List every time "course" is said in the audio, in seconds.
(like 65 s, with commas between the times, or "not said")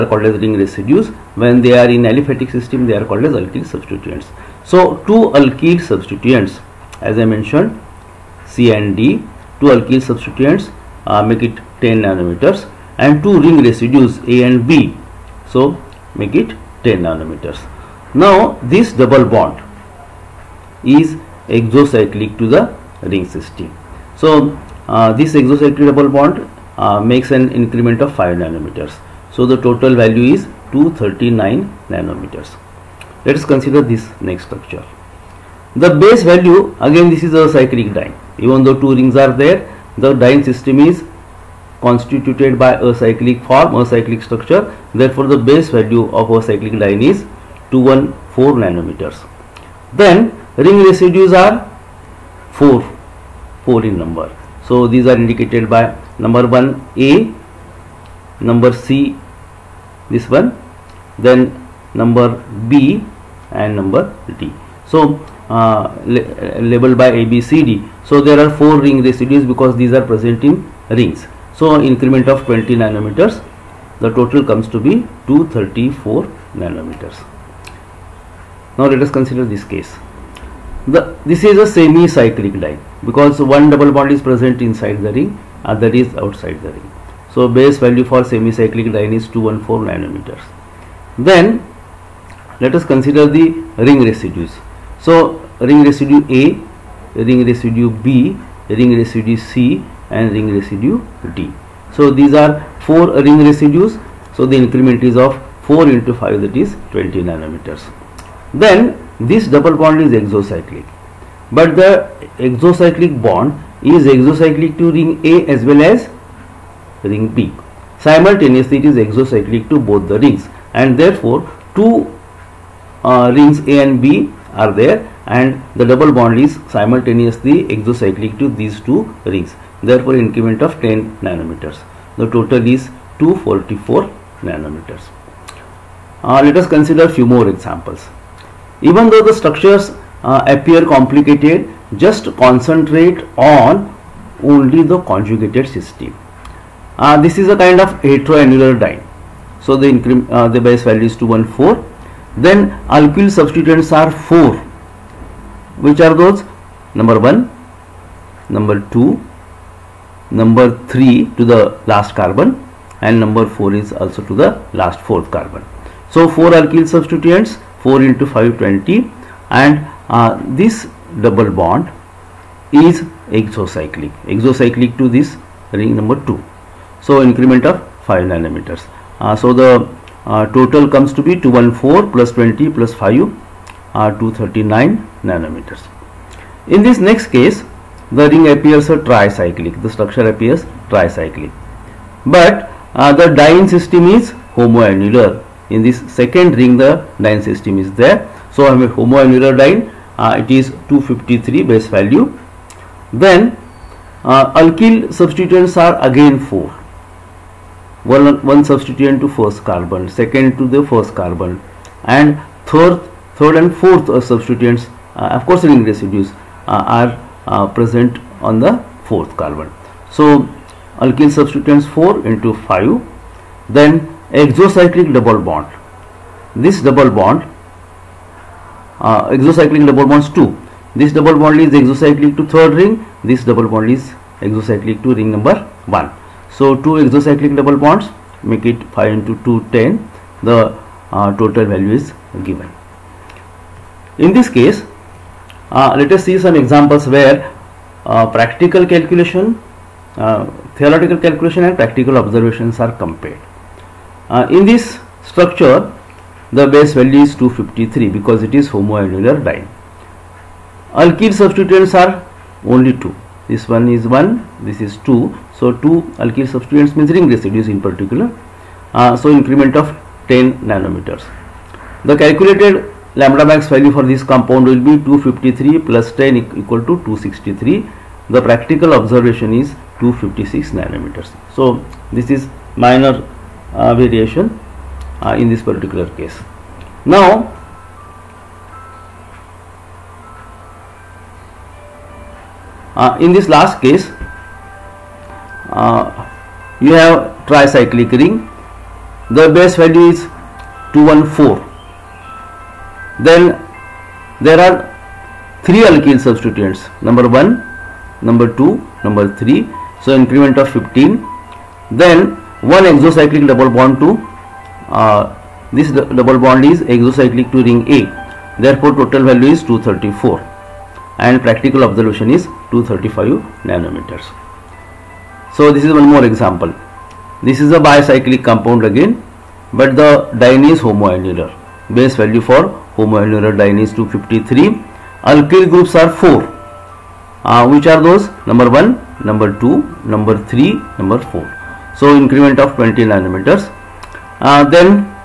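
215 s.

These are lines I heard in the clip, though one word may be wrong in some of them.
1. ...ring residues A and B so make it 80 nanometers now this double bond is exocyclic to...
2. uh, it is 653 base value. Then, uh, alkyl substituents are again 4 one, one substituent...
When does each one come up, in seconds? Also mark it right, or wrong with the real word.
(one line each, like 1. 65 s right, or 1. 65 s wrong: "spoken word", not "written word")
1. 13 s wrong: "10", not "80"
2. 200 s wrong: "253", not "653".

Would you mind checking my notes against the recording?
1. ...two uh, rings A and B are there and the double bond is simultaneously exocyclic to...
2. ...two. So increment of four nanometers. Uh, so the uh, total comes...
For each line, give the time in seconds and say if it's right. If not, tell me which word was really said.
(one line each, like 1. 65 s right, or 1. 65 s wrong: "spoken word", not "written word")
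1. 121 s right
2. 176 s wrong: "five", not "four".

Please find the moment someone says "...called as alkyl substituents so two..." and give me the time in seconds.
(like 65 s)
3 s.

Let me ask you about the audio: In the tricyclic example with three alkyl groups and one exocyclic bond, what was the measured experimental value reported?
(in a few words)
235 nanometers.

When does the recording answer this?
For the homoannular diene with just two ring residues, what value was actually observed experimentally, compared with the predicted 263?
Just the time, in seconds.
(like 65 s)
280 s.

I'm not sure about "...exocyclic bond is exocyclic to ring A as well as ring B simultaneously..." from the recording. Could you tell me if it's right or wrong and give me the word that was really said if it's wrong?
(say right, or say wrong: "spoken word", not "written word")
right.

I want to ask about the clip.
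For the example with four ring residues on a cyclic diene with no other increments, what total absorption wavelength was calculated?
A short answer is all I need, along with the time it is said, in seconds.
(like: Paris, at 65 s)
234 nanometers, at 75 s.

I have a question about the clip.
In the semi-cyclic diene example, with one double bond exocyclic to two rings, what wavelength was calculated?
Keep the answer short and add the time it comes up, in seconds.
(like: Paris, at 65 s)
244 nanometers, at 133 s.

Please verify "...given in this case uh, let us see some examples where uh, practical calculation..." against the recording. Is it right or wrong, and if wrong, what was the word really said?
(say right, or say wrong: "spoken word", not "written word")
right.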